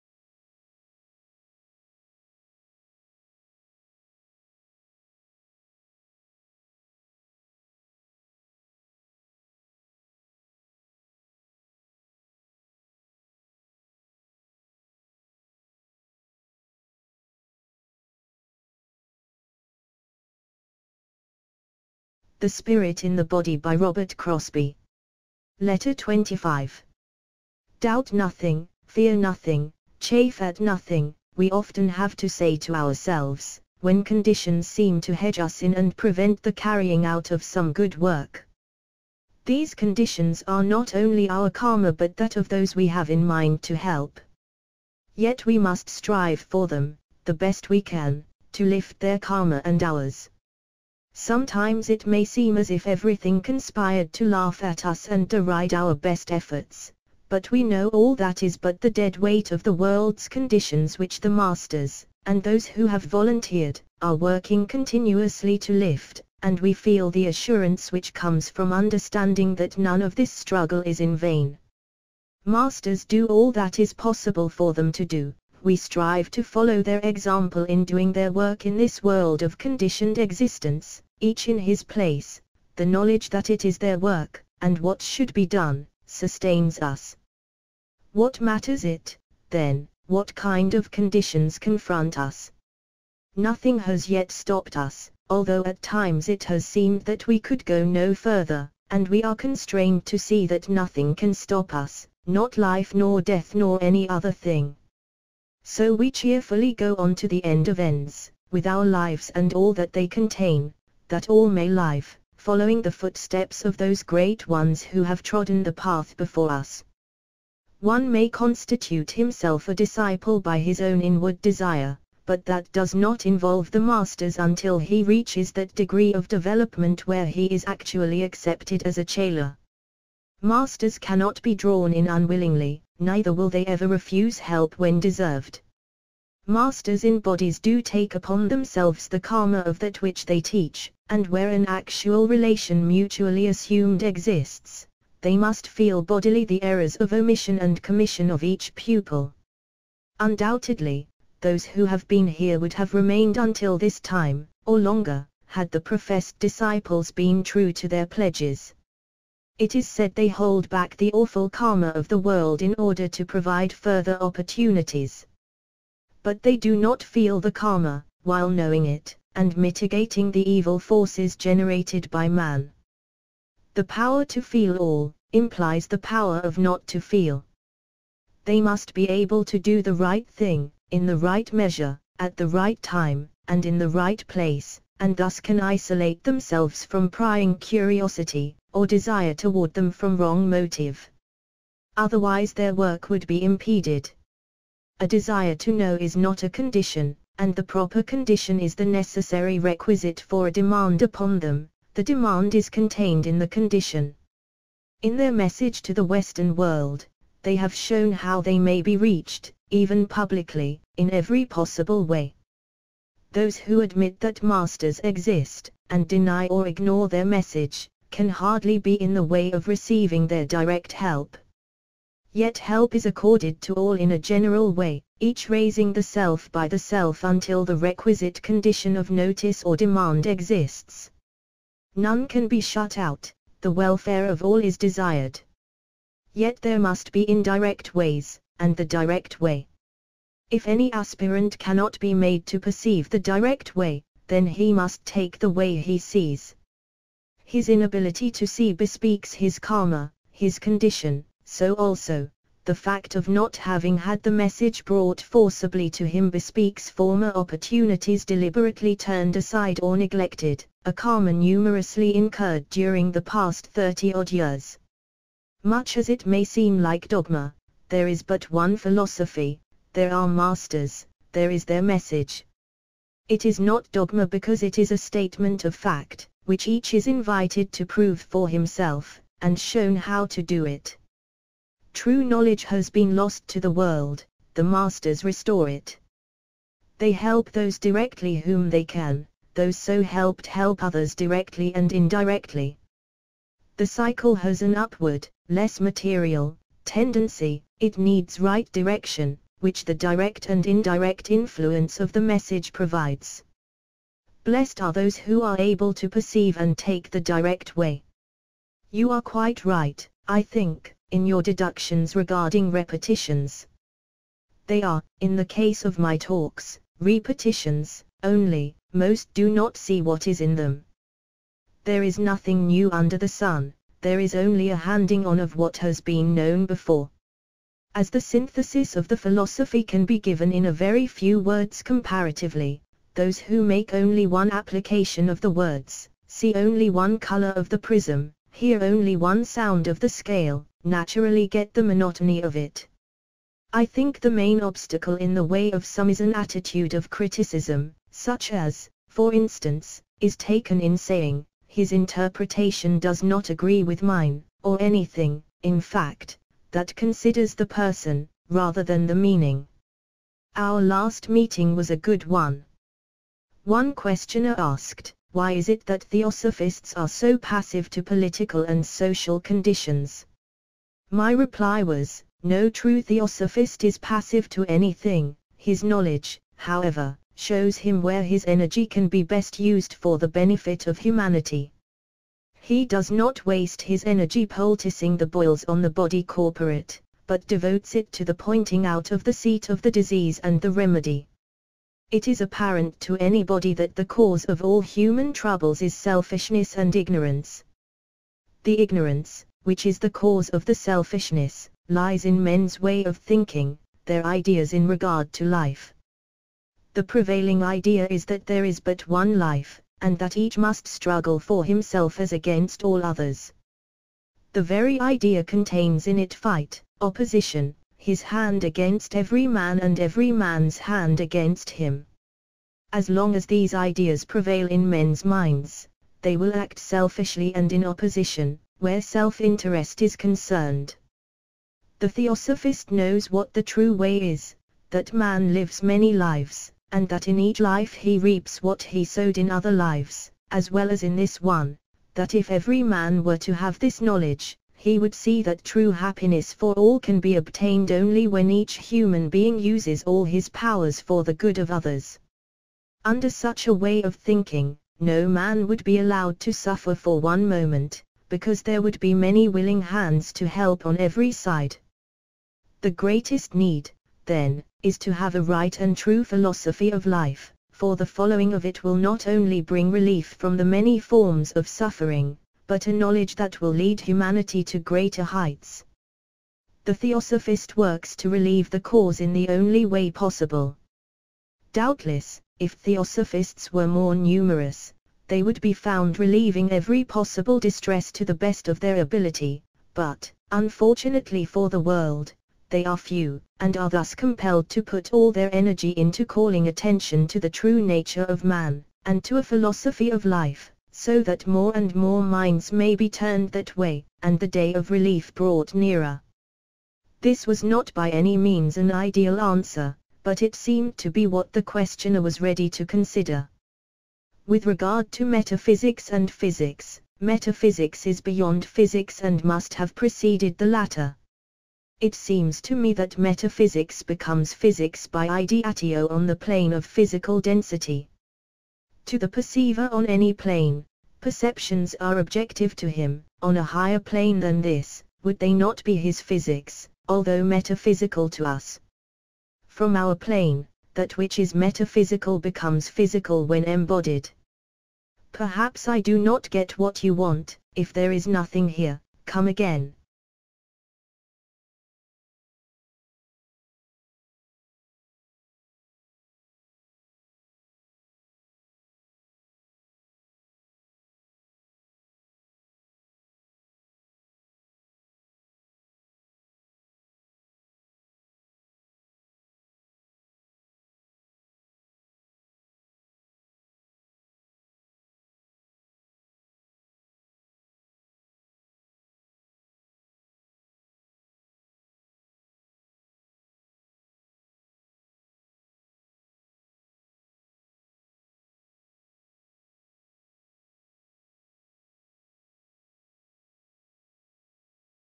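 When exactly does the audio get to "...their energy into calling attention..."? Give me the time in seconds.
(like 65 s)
495 s.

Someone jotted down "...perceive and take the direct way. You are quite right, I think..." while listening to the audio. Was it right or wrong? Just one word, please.
right.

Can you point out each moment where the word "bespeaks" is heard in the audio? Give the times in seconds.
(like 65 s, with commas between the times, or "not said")
248 s, 256 s.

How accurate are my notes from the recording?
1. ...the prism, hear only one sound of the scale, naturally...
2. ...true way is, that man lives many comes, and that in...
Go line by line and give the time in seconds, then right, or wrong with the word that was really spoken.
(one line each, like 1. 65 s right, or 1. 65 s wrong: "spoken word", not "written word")
1. 337 s right
2. 433 s wrong: "lives", not "comes".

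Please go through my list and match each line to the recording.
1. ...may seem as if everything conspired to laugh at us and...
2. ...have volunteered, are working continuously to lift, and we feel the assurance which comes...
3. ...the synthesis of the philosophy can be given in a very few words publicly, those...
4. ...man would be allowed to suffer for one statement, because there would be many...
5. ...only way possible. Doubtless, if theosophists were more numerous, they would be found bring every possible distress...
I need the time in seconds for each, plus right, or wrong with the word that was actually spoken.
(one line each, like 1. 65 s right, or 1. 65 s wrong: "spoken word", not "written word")
1. 52 s right
2. 62 s right
3. 328 s wrong: "comparatively", not "publicly"
4. 455 s wrong: "moment", not "statement"
5. 479 s wrong: "relieving", not "bring".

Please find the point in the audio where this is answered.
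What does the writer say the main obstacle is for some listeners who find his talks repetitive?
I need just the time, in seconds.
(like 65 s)
346 s.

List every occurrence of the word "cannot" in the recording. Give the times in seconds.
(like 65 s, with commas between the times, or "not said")
130 s, 241 s.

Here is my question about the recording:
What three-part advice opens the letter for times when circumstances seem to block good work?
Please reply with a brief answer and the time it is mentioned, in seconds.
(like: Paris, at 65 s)
Doubt nothing, fear nothing, chafe at nothing, at 27 s.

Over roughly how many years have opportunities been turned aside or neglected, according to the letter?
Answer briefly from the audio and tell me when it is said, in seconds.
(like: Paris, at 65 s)
30-odd years, at 263 s.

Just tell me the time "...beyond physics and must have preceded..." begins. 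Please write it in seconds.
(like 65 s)
518 s.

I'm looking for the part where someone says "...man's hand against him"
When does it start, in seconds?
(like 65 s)
420 s.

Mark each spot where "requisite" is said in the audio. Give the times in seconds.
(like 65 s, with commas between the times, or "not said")
199 s, 227 s.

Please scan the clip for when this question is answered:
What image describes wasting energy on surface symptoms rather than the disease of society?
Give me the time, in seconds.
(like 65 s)
384 s.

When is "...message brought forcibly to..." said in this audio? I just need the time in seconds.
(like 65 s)
254 s.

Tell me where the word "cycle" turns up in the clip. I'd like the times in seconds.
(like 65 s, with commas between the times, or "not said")
293 s.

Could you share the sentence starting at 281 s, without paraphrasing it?
True knowledge has been lost to the world, the masters restore it.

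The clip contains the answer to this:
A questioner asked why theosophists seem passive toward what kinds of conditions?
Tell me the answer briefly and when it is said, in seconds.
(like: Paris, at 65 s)
political and social, at 368 s.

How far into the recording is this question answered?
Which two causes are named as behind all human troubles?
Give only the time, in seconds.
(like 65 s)
395 s.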